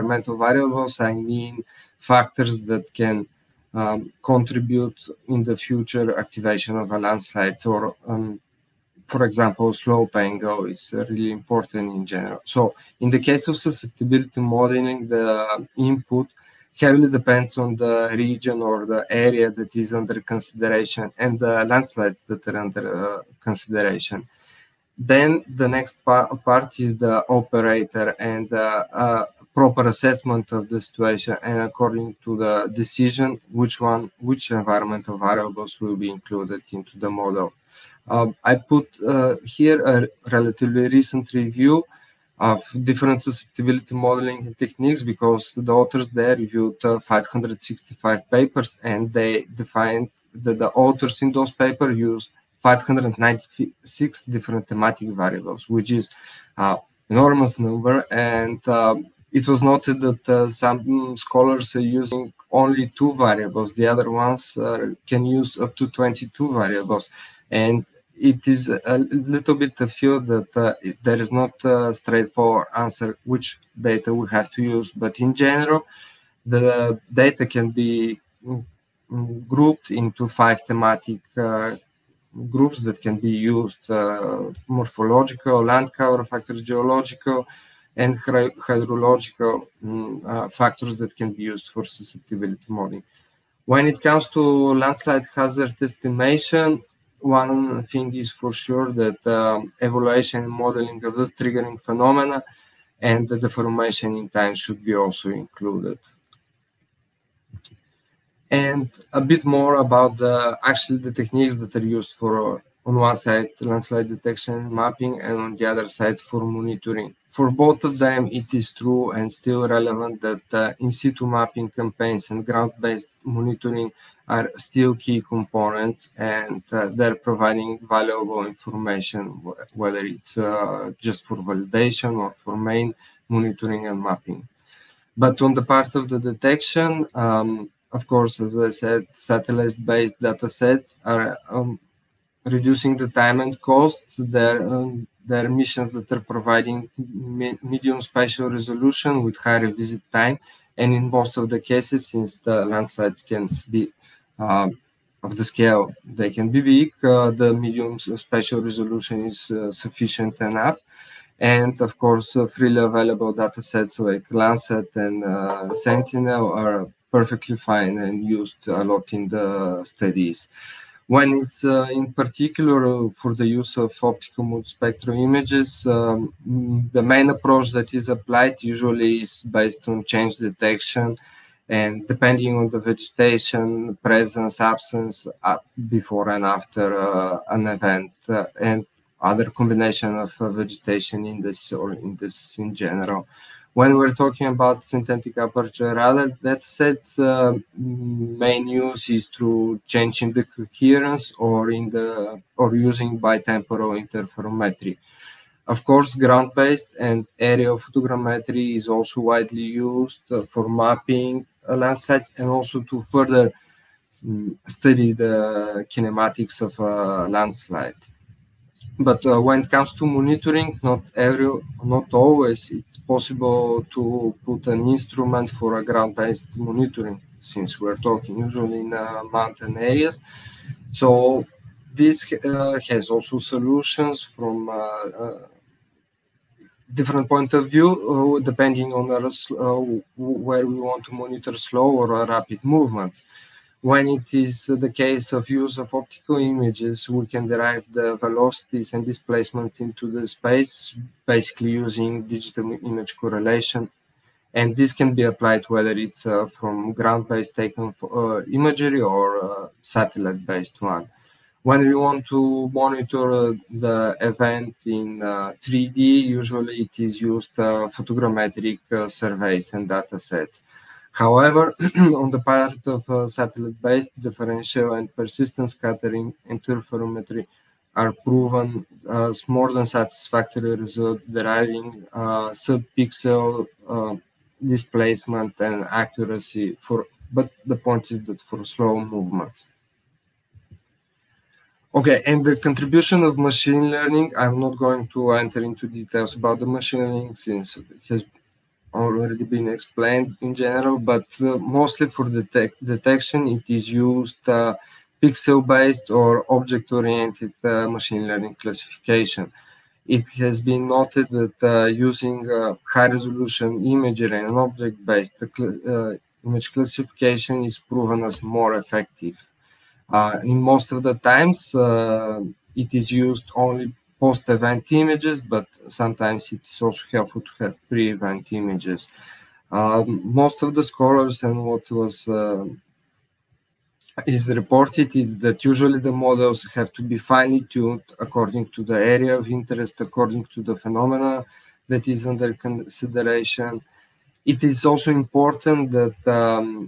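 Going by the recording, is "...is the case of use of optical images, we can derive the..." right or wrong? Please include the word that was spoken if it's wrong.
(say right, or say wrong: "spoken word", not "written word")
right.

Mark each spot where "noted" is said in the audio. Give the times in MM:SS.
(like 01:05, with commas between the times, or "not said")
00:59, 05:10.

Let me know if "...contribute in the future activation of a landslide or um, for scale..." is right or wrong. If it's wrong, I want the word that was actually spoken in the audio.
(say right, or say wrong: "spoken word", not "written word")
wrong: "example", not "scale".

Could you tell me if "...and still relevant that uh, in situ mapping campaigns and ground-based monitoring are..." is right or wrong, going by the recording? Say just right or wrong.
right.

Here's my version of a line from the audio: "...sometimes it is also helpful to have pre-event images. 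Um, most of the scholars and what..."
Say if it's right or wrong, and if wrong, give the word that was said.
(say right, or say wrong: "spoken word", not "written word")
right.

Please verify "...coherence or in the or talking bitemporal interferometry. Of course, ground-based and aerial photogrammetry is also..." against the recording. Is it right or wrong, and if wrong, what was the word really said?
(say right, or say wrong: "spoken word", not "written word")
wrong: "using", not "talking".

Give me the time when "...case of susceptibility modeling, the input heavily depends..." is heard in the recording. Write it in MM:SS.
00:13.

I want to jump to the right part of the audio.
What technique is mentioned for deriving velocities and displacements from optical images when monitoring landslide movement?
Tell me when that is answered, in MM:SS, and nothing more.
04:12.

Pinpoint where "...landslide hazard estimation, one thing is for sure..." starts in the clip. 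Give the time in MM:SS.
01:34.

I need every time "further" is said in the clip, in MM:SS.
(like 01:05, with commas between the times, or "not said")
03:33.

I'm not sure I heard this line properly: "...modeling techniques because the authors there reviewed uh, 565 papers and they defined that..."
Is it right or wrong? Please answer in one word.
right.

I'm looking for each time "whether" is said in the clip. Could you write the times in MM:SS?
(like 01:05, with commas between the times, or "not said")
02:09, 04:15.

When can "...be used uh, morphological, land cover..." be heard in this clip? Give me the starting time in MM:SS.
01:23.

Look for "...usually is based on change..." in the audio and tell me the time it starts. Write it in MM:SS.
02:58.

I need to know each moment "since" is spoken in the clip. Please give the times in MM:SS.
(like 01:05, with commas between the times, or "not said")
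02:32, 03:47, 04:57.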